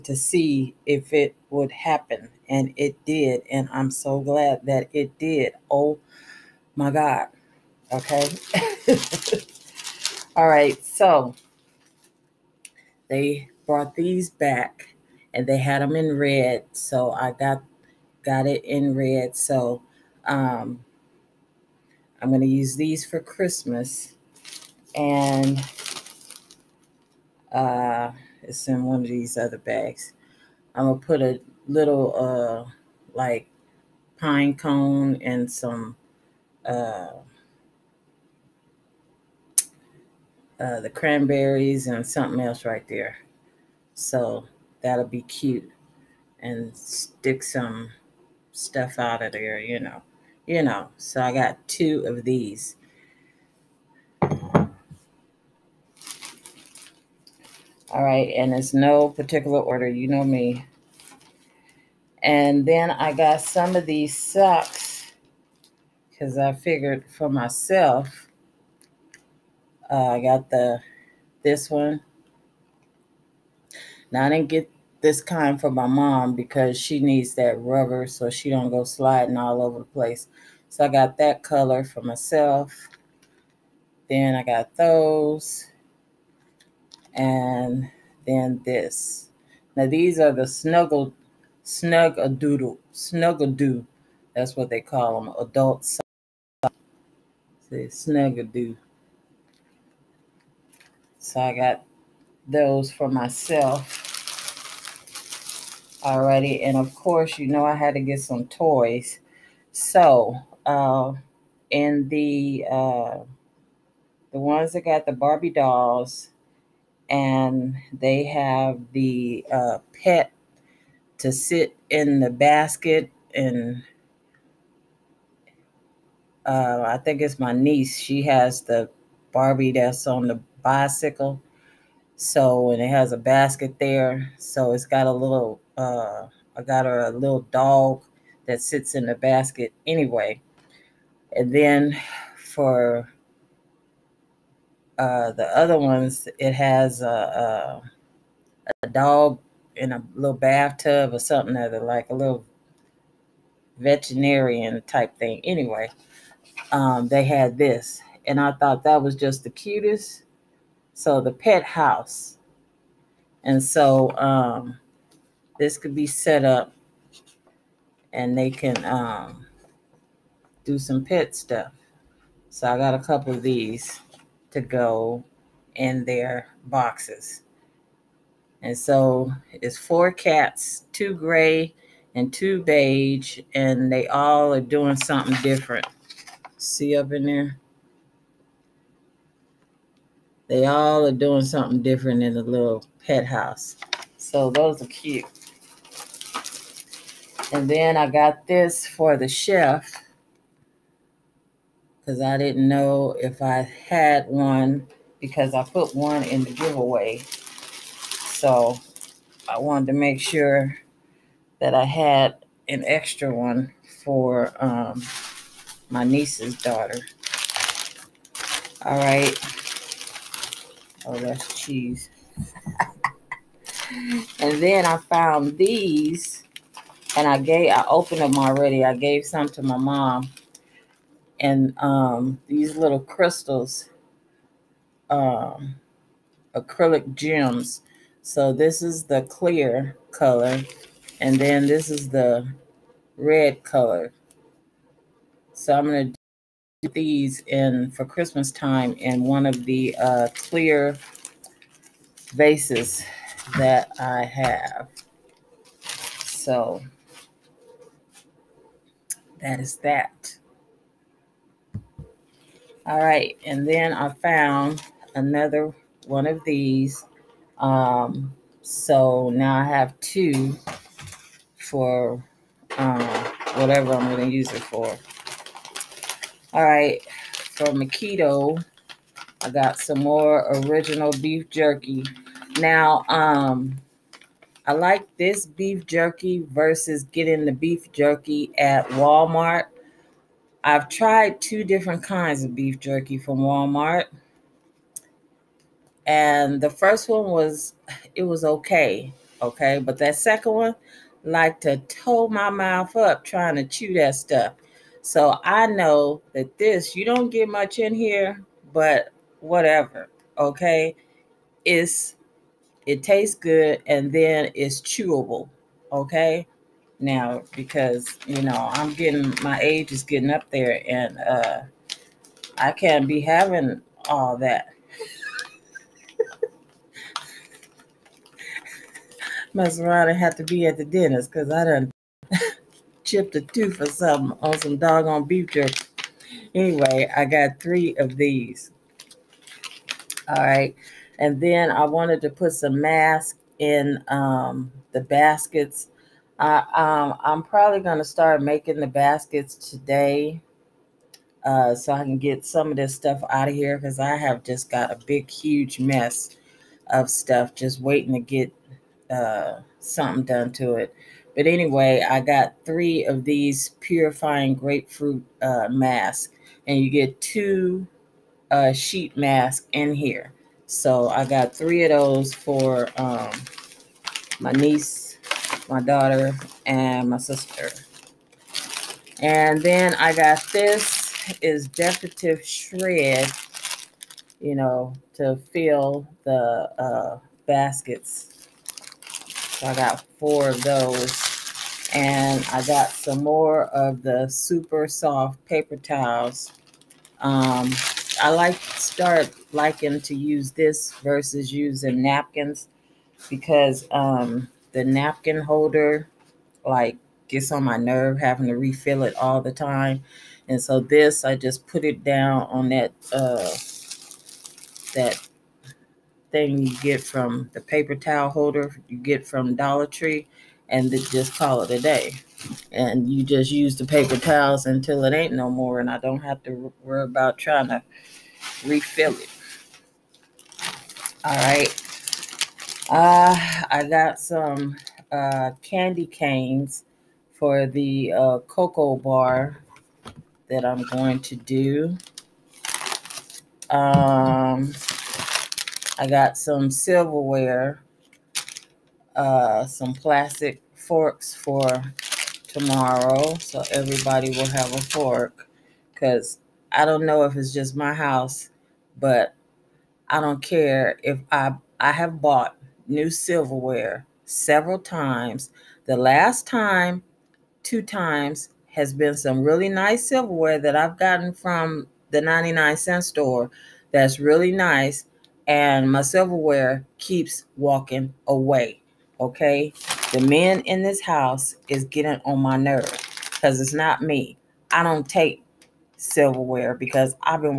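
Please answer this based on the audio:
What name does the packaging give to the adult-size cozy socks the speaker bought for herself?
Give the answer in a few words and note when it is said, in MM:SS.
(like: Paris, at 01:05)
snuggadoo, at 01:38.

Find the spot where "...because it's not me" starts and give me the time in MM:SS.
08:03.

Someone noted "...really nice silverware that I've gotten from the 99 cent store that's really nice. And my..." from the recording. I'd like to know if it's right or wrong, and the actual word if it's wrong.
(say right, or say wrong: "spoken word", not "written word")
right.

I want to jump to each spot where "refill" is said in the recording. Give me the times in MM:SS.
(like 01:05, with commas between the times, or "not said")
06:48, 07:08.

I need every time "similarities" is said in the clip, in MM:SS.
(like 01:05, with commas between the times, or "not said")
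not said.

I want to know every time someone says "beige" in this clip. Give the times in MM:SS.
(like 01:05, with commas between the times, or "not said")
03:02.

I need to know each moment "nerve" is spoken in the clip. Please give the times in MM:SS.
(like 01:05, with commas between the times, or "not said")
06:47, 08:02.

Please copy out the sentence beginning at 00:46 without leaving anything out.
And stick some stuff out of there, you know.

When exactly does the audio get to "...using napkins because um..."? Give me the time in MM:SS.
06:41.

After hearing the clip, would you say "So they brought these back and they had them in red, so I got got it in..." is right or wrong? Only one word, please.
right.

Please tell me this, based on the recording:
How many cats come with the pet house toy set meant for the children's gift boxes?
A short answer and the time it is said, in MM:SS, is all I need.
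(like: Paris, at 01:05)
4, at 02:59.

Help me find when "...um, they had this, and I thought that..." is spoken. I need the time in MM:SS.
02:36.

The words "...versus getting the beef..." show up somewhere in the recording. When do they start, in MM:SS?
04:46.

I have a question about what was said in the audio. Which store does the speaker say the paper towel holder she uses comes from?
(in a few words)
Dollar Tree.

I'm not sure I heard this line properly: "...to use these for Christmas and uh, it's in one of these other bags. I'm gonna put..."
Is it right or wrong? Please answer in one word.
right.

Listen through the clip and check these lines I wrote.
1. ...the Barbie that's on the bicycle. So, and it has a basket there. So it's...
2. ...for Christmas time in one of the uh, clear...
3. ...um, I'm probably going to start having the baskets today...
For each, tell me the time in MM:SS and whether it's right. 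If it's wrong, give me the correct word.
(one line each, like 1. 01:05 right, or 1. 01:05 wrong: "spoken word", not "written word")
1. 02:08 right
2. 04:07 right
3. 05:46 wrong: "making", not "having".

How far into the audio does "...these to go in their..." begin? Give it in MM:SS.
02:53.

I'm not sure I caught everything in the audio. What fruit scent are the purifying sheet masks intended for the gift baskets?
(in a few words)
grapefruit.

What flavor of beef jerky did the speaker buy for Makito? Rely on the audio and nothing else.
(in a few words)
original.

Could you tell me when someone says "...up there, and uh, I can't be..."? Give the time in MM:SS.
05:20.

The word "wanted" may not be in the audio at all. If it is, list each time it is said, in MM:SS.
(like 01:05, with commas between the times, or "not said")
03:29, 05:41.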